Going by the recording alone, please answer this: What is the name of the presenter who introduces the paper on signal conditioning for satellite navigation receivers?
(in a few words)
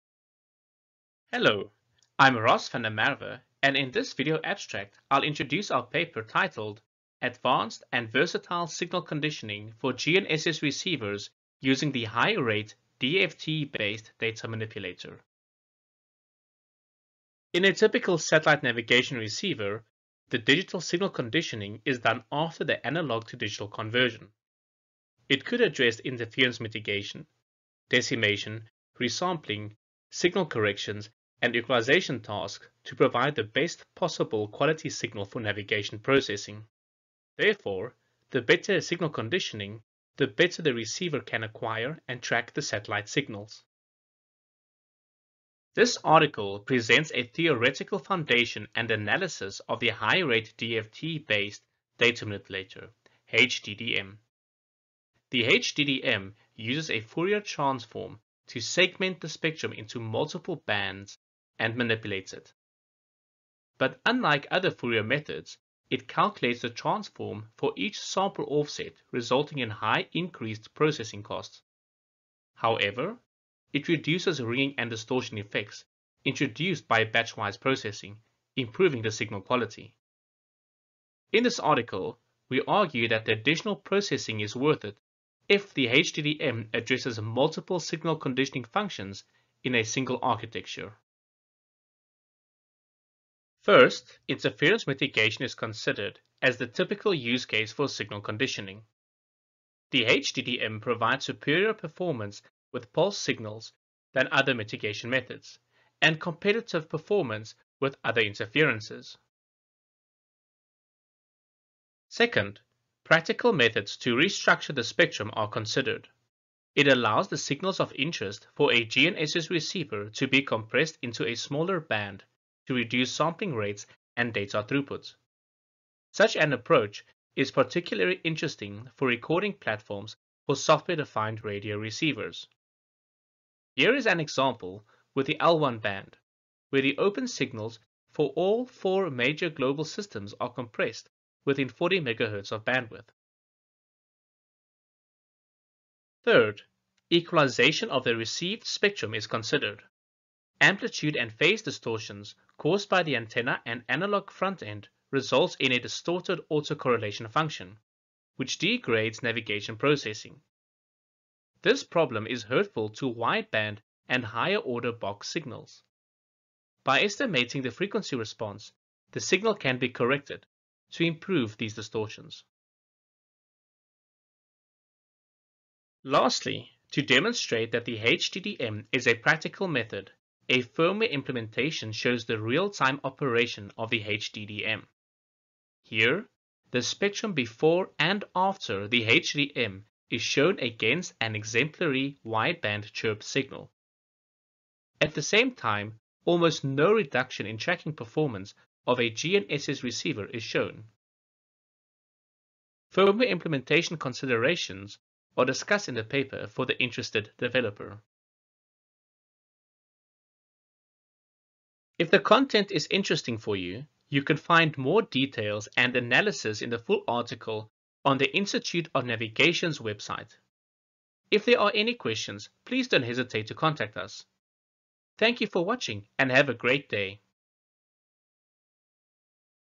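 Ross van der Merwe.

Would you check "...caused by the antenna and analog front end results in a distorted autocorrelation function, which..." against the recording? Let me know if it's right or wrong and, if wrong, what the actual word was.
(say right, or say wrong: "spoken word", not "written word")
right.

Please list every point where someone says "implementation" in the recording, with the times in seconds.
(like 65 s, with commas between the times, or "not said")
181 s, 203 s.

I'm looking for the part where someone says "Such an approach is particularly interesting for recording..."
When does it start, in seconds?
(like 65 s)
126 s.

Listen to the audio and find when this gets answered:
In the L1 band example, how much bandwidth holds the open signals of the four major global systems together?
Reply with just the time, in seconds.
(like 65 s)
141 s.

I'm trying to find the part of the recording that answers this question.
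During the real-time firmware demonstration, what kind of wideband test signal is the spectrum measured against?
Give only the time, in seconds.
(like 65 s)
192 s.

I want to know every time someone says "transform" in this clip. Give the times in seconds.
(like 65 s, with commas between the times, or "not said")
57 s, 66 s.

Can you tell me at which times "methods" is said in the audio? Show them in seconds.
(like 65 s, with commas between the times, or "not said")
65 s, 105 s, 113 s, 179 s.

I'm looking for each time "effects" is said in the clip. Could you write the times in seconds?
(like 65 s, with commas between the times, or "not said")
75 s.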